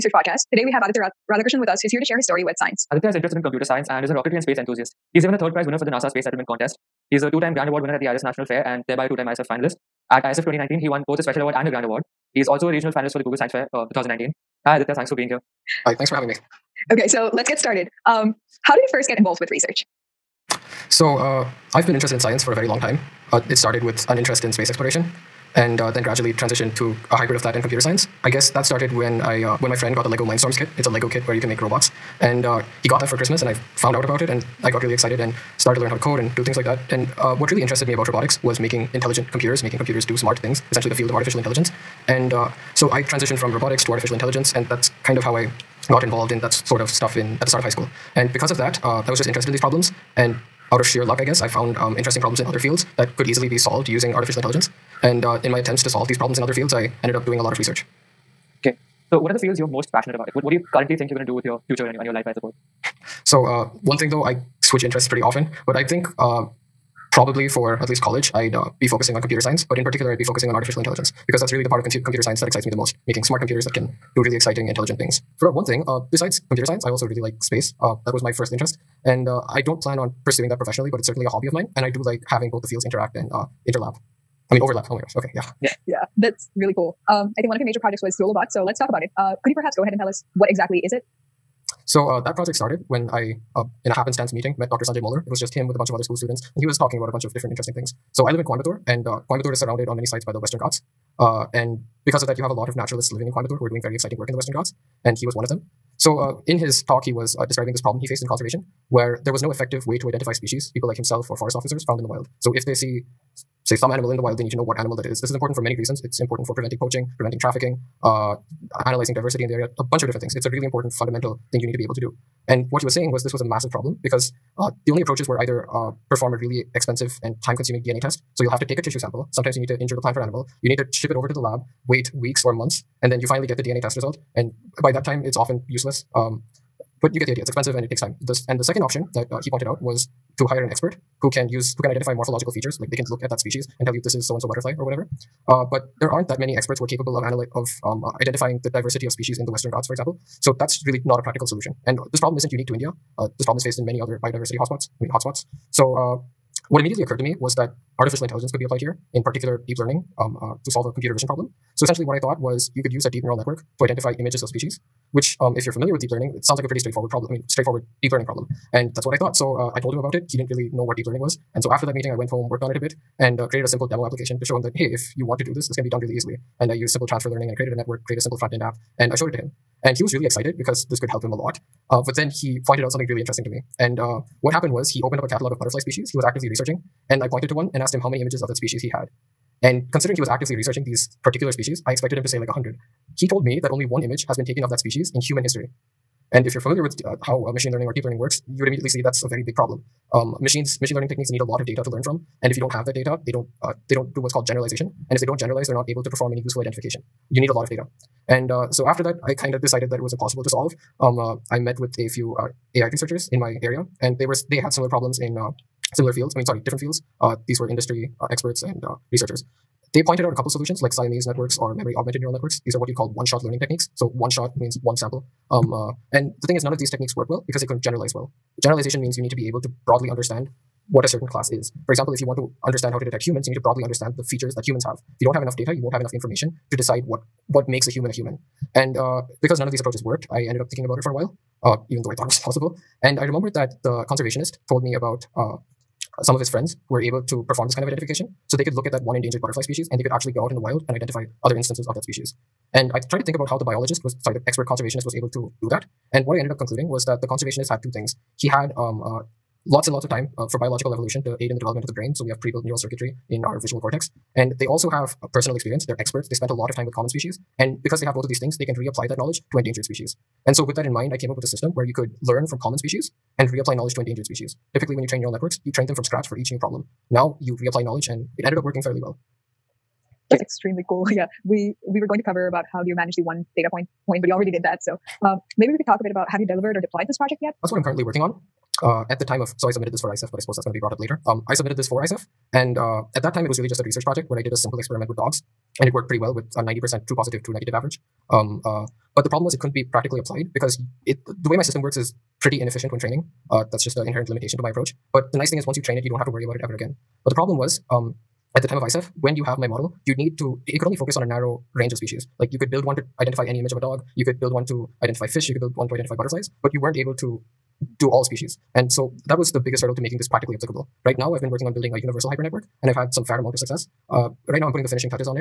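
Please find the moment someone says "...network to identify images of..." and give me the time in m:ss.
2:43.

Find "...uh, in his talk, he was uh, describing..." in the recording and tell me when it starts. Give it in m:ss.
1:46.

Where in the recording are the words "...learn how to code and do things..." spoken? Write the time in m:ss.
0:35.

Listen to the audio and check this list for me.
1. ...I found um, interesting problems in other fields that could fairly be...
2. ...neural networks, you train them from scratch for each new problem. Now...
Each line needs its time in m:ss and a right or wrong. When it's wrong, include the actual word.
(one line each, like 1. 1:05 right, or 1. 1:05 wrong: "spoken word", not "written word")
1. 0:51 wrong: "easily", not "fairly"
2. 4:35 right.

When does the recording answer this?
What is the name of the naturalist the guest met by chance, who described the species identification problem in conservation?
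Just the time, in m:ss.
1:34.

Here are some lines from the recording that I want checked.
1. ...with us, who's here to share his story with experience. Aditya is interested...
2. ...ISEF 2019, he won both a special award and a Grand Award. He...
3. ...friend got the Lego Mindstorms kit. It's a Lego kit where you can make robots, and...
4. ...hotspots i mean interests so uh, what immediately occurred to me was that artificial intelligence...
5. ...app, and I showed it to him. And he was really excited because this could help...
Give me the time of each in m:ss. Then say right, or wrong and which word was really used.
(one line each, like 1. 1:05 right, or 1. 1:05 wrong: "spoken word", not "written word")
1. 0:01 wrong: "science", not "experience"
2. 0:10 right
3. 0:29 right
4. 2:34 wrong: "hotspots", not "interests"
5. 2:58 right.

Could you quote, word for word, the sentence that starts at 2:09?
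Sometimes you need to injure the plant or animal.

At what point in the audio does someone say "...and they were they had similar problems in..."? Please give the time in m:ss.
3:34.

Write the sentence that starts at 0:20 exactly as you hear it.
So, uh, I've been interested in science for a very long time.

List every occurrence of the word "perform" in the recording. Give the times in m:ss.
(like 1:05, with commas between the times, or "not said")
2:06, 3:26, 4:07.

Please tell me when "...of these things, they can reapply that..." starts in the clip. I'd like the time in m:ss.
4:28.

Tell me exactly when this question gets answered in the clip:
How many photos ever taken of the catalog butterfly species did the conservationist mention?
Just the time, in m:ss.
3:13.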